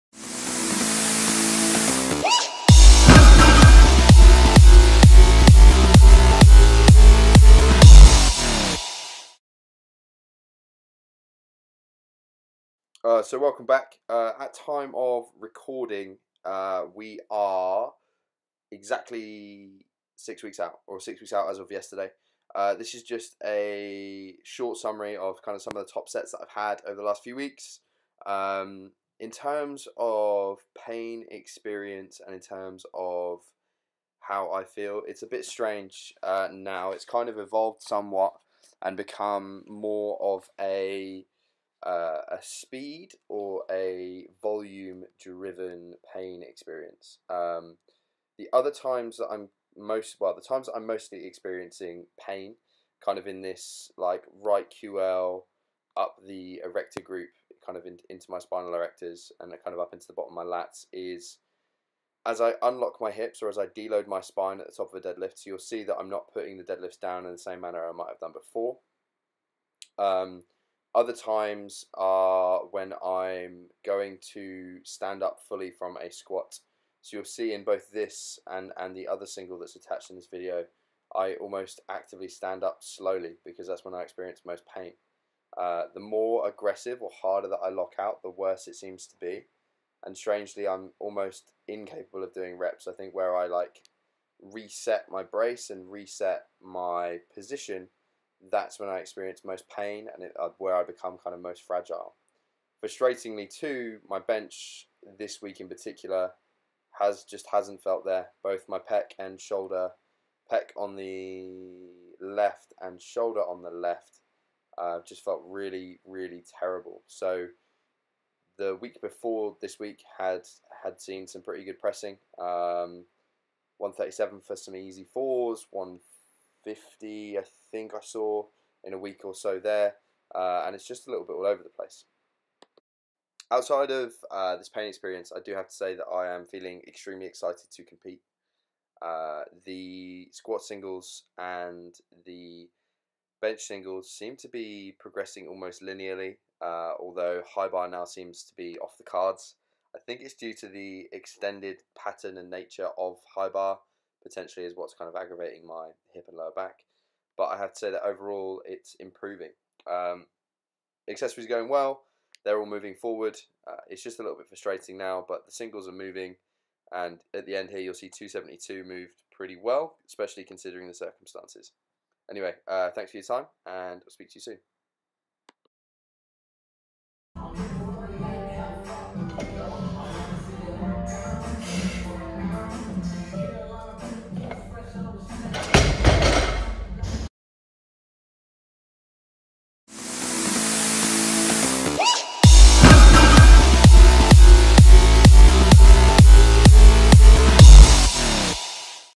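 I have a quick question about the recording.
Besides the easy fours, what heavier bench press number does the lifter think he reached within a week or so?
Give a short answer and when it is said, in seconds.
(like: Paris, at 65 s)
150, at 125 s.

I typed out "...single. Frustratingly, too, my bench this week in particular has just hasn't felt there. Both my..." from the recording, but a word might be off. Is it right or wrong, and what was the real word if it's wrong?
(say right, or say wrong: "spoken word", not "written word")
wrong: "fragile", not "single".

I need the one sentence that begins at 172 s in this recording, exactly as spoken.
Anyway, uh, thanks for your time, and I'll speak to you soon.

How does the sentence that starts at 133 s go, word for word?
Outside of uh, this pain experience, I do have to say that I am feeling extremely excited to compete.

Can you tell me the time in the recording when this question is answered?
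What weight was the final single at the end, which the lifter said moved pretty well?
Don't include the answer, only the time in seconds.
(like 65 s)
168 s.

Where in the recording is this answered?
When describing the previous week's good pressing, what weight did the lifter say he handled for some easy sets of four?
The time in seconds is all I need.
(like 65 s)
123 s.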